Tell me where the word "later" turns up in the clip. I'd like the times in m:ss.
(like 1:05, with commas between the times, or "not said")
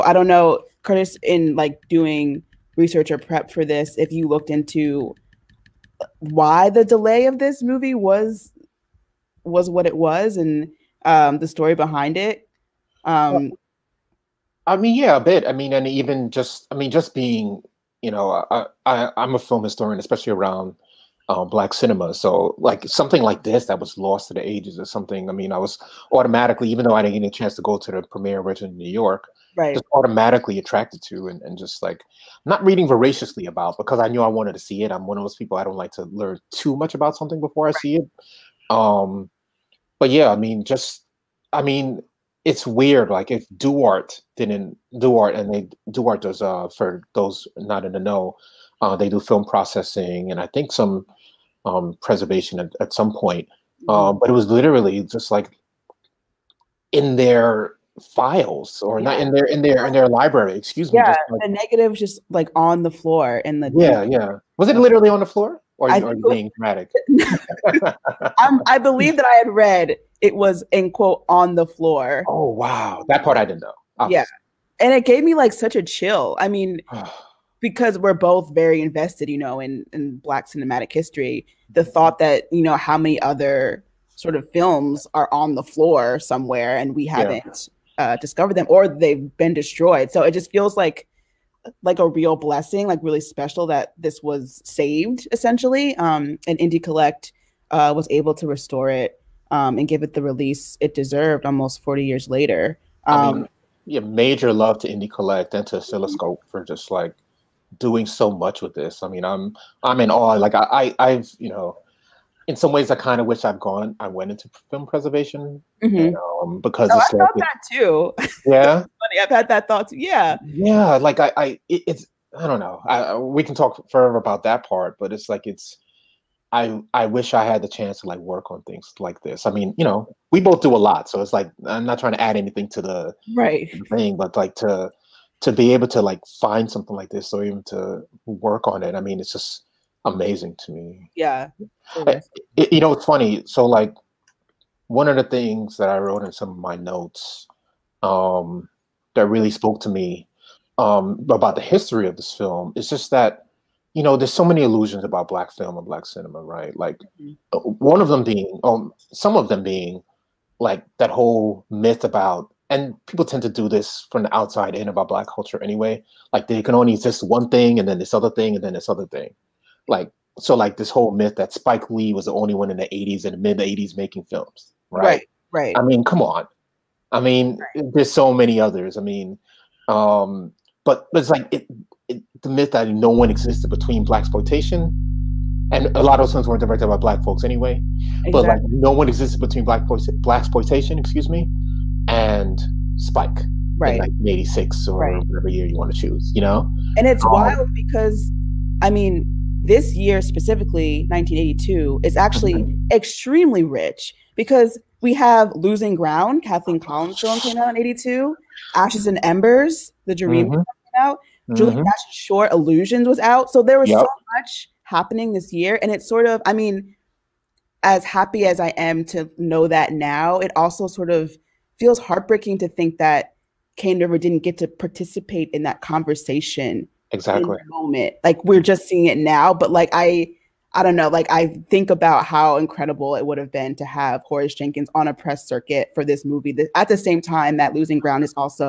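1:42.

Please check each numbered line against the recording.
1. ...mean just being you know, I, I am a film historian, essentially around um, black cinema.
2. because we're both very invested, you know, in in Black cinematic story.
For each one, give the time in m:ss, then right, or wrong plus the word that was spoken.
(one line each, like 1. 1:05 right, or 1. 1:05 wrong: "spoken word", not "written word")
1. 0:16 wrong: "especially", not "essentially"
2. 1:17 wrong: "history", not "story".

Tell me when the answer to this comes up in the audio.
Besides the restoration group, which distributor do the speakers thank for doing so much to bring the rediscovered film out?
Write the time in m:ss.
1:45.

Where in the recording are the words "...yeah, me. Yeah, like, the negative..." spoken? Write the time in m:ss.
1:00.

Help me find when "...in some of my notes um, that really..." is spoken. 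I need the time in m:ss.
2:26.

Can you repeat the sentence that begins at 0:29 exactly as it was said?
just automatically attracted to and, and just like not reading voraciously about because I knew I wanted to see it.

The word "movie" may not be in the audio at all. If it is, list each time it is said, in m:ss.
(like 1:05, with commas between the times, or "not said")
0:07, 3:56.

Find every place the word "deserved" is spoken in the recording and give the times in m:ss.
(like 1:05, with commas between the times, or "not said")
1:40.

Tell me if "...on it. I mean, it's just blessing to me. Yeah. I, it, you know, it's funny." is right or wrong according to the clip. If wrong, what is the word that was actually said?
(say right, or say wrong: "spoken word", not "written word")
wrong: "amazing", not "blessing".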